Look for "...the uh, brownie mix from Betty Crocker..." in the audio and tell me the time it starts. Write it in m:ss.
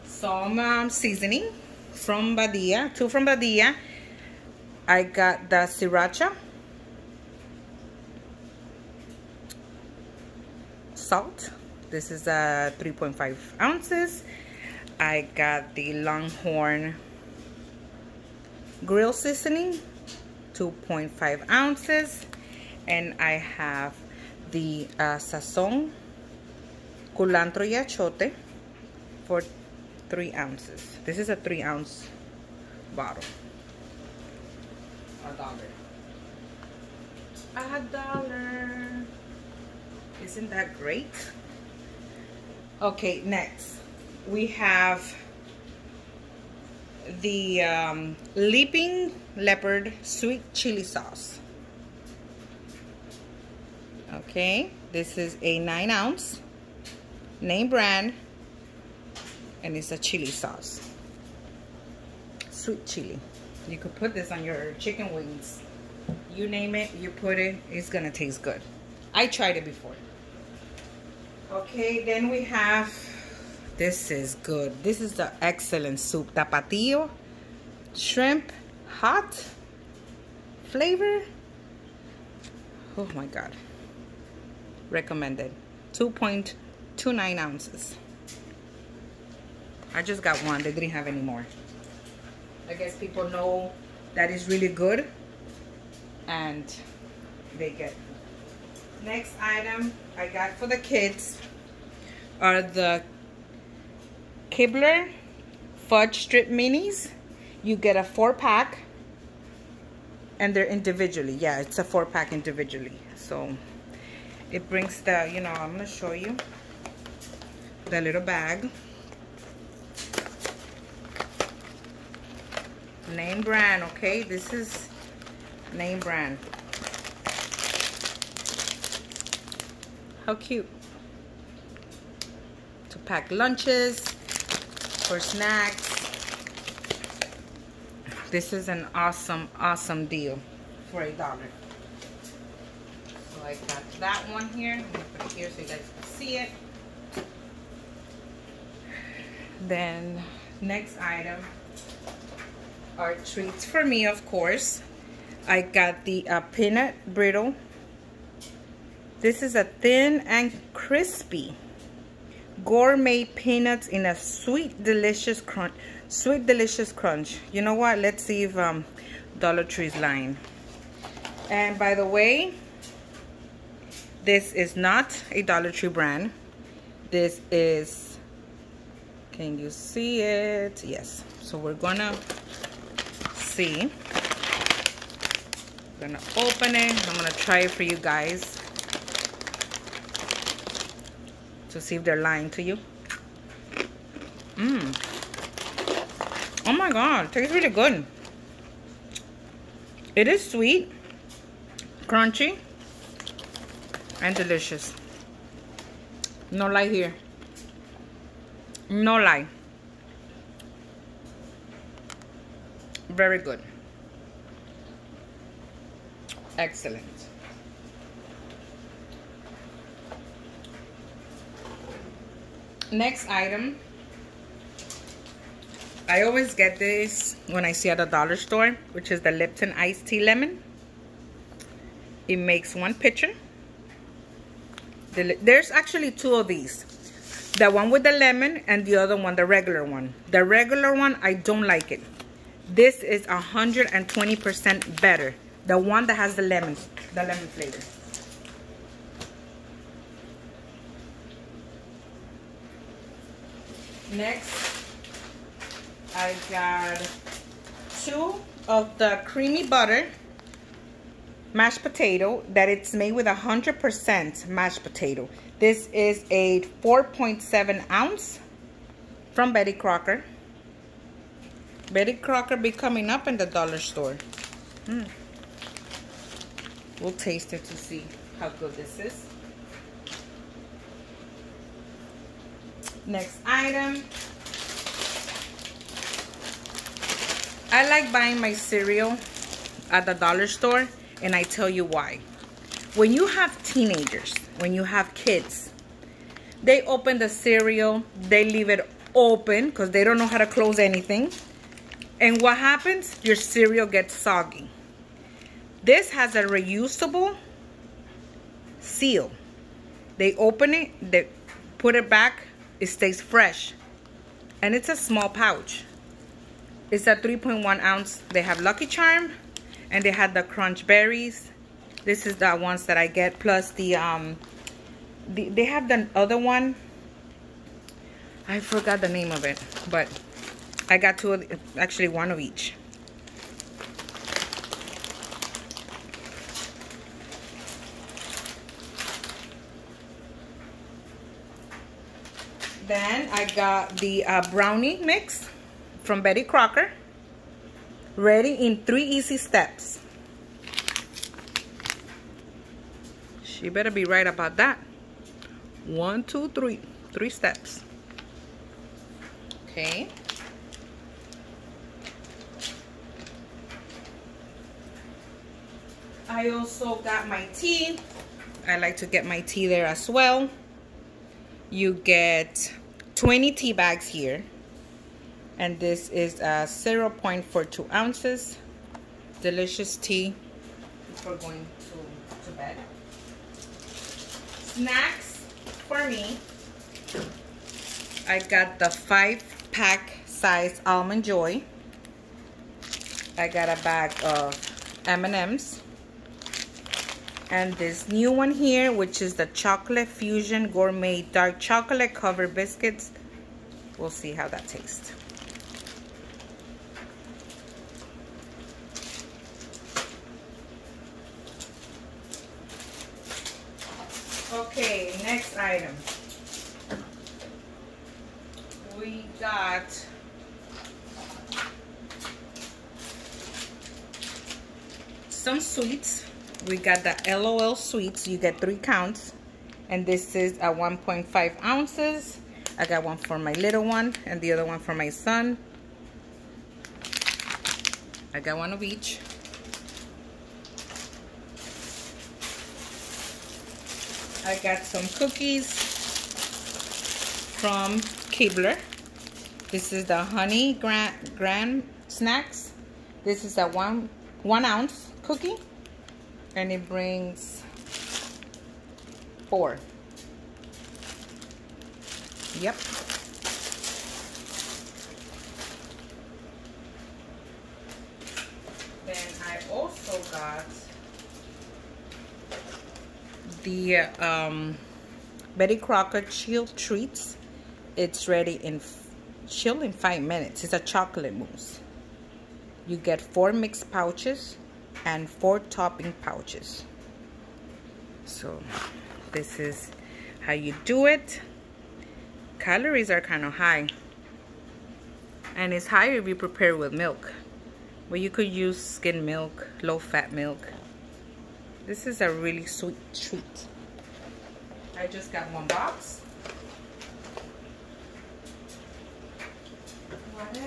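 5:43.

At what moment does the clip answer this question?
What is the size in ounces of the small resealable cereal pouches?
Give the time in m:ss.
5:17.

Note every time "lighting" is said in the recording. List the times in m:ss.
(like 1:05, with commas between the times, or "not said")
not said.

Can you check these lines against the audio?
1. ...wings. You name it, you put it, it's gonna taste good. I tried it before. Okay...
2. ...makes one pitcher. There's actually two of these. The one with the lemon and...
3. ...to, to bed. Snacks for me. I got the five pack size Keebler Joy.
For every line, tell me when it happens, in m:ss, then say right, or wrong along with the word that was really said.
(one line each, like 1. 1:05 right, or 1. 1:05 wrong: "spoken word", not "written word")
1. 1:05 right
2. 3:52 right
3. 6:21 wrong: "Almond", not "Keebler".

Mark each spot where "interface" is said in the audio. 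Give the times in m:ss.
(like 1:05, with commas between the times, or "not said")
not said.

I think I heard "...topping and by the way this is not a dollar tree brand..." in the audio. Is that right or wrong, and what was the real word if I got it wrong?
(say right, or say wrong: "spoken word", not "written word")
wrong: "lying", not "topping".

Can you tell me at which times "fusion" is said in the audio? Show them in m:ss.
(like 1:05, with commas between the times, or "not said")
6:40.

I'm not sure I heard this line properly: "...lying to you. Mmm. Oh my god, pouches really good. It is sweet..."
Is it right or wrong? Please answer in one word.
wrong.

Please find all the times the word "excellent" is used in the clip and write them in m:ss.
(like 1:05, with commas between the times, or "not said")
1:15, 3:36.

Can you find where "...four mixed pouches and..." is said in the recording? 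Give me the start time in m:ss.
8:03.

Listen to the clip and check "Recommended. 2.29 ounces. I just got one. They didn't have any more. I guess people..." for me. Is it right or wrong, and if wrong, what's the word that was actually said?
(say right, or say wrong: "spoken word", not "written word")
right.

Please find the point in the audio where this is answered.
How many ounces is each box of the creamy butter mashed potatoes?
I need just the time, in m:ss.
4:26.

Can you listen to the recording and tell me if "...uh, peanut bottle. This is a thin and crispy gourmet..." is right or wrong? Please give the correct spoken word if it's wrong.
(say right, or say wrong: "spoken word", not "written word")
wrong: "brittle", not "bottle".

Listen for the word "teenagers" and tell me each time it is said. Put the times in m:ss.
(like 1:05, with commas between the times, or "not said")
4:53.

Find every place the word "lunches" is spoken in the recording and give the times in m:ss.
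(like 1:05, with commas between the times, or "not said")
2:13.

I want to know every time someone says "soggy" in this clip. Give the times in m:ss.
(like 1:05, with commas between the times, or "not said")
5:04.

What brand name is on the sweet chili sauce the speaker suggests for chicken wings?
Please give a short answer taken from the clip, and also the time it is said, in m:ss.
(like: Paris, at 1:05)
Leaping Leopard, at 0:48.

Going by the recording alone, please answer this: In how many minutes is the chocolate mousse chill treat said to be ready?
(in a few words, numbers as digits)
5 minutes.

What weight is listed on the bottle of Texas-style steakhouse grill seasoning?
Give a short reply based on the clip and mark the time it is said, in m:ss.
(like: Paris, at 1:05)
2.5 ounces, at 0:20.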